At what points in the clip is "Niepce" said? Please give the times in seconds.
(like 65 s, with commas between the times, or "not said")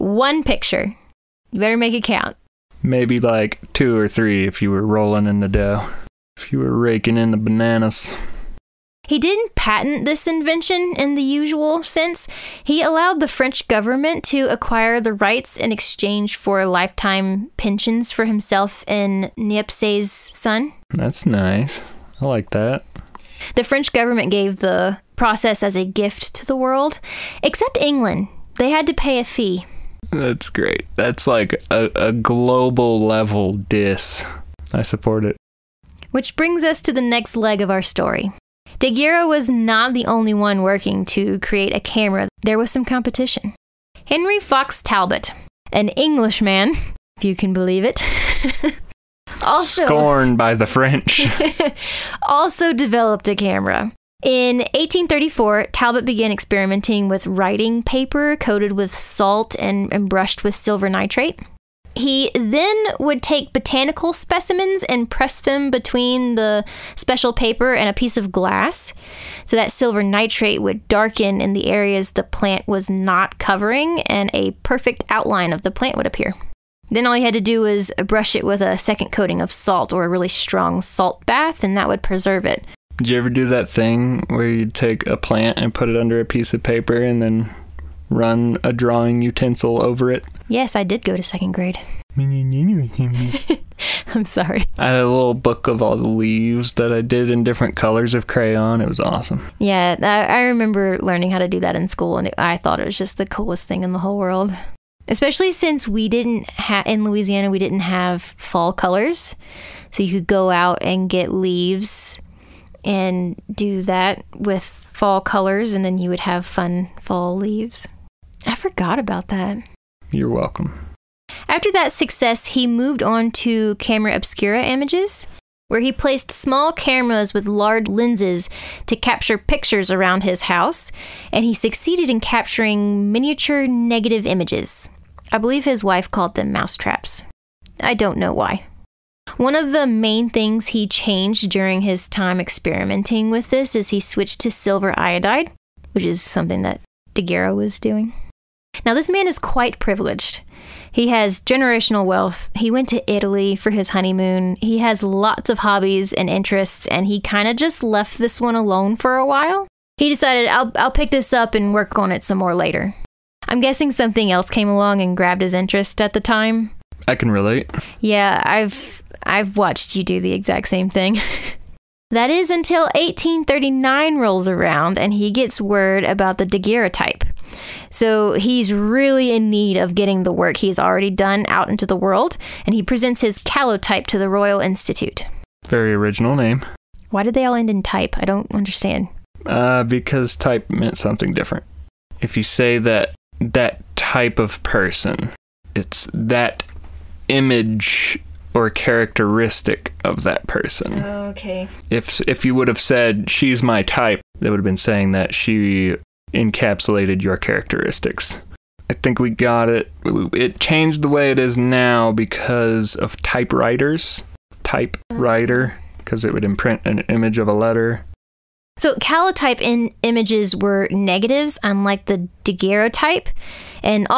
19 s.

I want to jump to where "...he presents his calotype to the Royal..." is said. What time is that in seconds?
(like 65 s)
182 s.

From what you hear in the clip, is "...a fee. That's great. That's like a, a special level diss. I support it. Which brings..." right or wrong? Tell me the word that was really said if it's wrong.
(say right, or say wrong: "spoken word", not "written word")
wrong: "global", not "special".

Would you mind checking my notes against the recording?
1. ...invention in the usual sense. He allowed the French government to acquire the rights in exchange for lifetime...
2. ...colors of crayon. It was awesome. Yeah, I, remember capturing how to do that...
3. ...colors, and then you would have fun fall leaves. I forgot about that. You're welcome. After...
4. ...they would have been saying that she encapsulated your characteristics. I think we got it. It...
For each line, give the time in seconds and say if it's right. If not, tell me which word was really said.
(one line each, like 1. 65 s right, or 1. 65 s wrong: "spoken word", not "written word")
1. 10 s right
2. 97 s wrong: "learning", not "capturing"
3. 115 s right
4. 204 s right.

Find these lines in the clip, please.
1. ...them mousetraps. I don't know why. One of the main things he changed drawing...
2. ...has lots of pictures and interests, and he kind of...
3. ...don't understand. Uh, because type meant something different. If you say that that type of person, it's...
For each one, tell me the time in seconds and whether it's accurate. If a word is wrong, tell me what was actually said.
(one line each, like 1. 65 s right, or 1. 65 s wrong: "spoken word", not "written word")
1. 136 s wrong: "during", not "drawing"
2. 154 s wrong: "hobbies", not "pictures"
3. 188 s right.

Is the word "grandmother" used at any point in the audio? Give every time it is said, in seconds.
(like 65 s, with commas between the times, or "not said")
not said.